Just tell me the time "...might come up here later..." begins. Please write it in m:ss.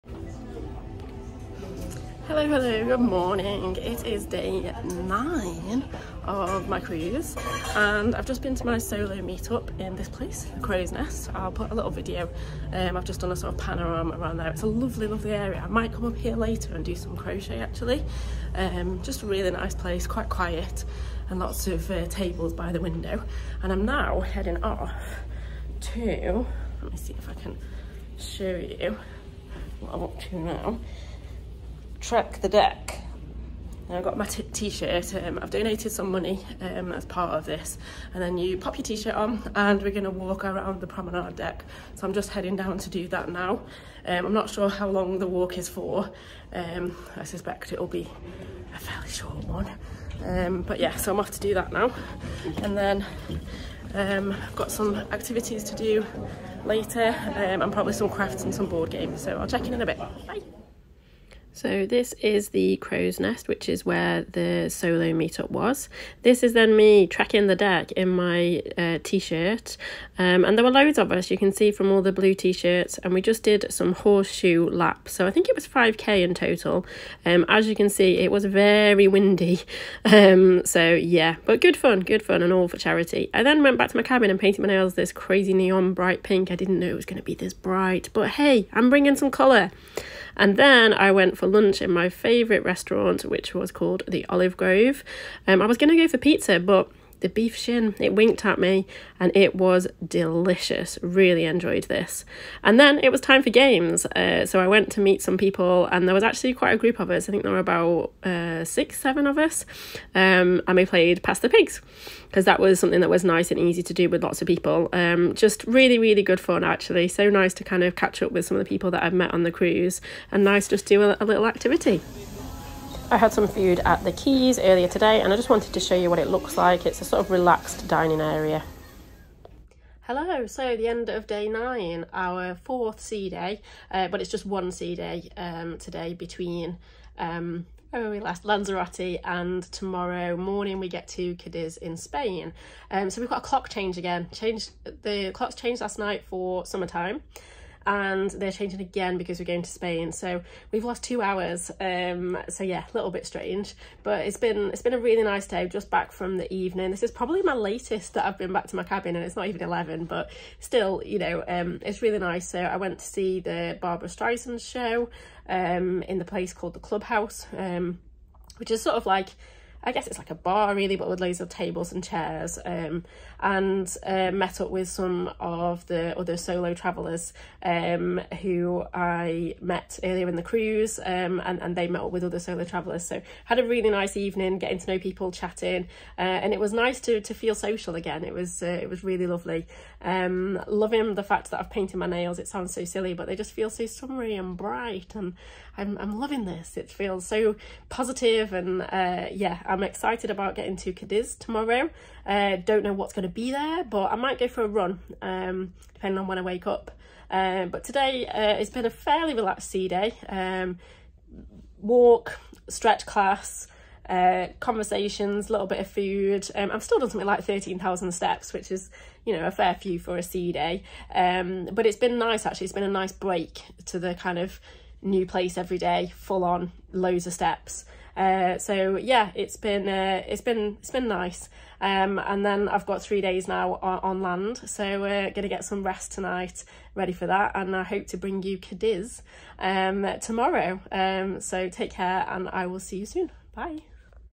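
0:15.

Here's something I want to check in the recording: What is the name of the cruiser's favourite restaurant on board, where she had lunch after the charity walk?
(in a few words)
Olive Grove.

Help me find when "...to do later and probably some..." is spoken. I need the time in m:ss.
0:55.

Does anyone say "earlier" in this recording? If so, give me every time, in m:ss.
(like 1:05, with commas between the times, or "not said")
2:04, 3:00.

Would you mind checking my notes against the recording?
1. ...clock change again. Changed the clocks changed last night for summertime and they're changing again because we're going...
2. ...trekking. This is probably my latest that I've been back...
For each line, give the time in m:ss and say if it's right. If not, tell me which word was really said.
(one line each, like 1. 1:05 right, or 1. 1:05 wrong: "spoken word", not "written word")
1. 2:23 right
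2. 2:36 wrong: "evening", not "trekking".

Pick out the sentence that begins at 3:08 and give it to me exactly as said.
It was uh, it was really lovely.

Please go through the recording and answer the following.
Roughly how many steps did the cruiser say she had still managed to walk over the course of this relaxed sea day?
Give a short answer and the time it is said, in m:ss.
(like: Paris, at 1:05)
13,000, at 3:37.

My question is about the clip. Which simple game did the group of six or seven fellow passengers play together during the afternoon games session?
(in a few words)
Pass the Pigs.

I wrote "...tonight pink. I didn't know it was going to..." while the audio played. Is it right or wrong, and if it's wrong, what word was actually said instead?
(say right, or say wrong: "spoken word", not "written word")
wrong: "bright", not "tonight".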